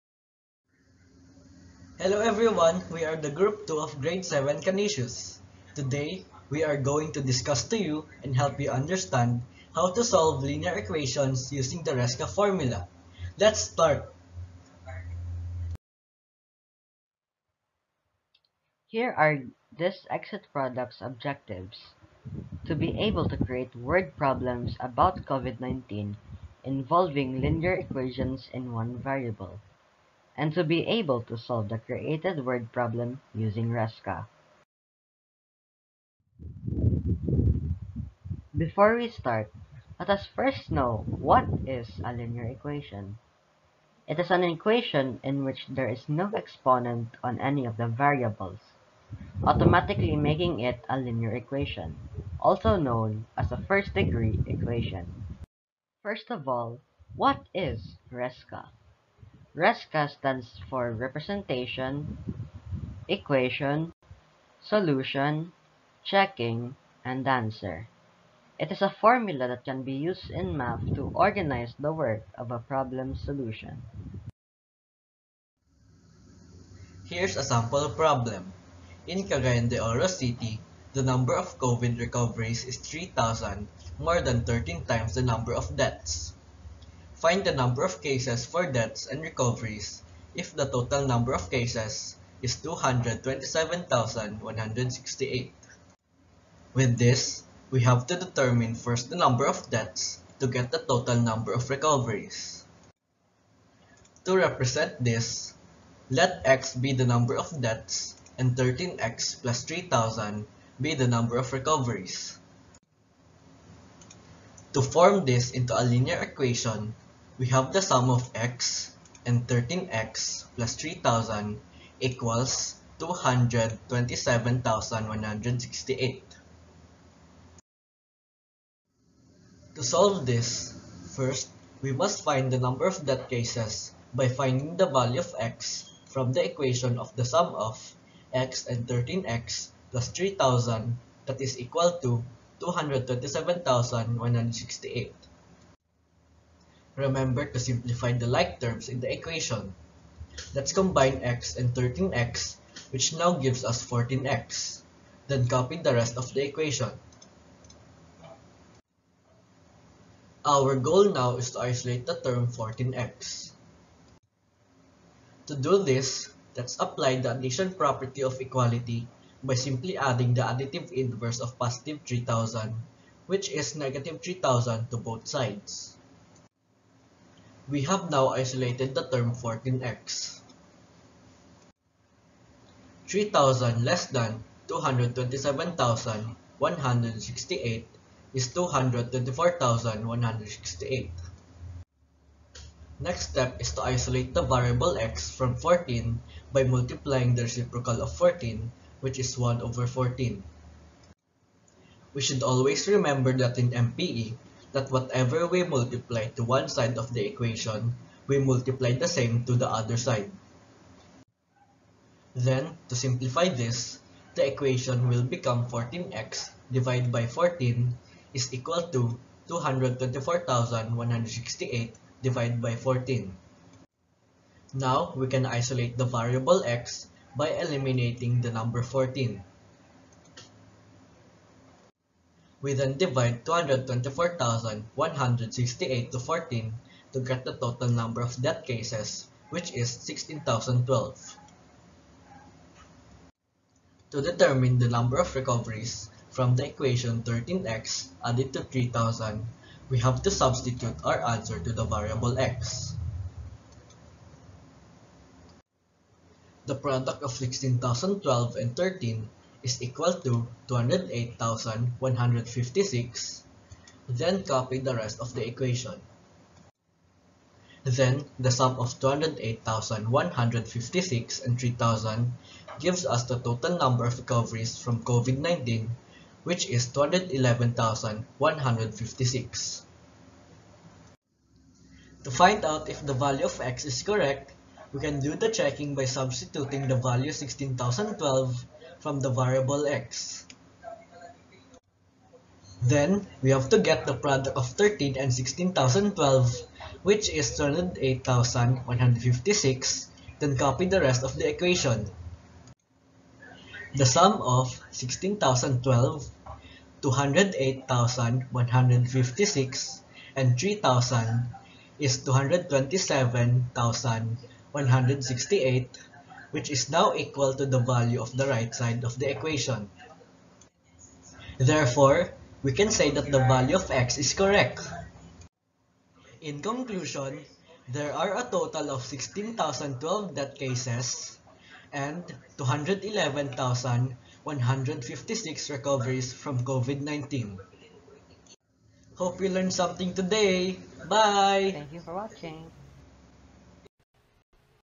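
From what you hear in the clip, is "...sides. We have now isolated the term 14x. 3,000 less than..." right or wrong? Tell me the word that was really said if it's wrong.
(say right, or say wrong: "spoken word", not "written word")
right.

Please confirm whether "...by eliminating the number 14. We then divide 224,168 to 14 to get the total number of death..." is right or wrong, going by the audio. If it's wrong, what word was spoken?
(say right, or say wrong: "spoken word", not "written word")
right.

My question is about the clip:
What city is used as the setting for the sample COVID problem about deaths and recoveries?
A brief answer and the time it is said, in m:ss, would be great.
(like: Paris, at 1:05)
Cagayan de Oro City, at 1:19.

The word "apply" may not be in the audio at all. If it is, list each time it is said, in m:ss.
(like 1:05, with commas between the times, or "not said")
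2:46.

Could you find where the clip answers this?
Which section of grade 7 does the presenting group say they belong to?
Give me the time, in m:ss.
0:04.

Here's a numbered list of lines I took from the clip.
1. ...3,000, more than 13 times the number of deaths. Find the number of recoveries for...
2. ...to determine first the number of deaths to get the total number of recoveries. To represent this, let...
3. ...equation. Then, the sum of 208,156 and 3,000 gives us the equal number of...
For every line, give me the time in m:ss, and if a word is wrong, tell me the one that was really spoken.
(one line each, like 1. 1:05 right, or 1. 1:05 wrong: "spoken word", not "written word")
1. 1:22 wrong: "cases", not "recoveries"
2. 1:38 right
3. 4:25 wrong: "total", not "equal".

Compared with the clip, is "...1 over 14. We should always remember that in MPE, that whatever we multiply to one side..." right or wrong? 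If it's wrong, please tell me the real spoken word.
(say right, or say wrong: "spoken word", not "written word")
right.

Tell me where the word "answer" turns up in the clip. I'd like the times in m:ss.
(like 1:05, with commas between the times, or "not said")
1:07, 4:11.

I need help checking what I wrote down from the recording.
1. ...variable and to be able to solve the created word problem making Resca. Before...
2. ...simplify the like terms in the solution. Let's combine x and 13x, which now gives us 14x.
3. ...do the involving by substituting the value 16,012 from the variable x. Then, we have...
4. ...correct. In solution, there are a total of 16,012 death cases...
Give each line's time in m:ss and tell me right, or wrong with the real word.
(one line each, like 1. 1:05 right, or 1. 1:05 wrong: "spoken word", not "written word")
1. 0:28 wrong: "using", not "making"
2. 2:27 wrong: "equation", not "solution"
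3. 4:45 wrong: "checking", not "involving"
4. 5:24 wrong: "conclusion", not "solution".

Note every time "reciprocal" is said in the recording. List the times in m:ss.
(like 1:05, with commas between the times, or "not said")
3:17.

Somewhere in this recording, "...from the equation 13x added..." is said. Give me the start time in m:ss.
4:06.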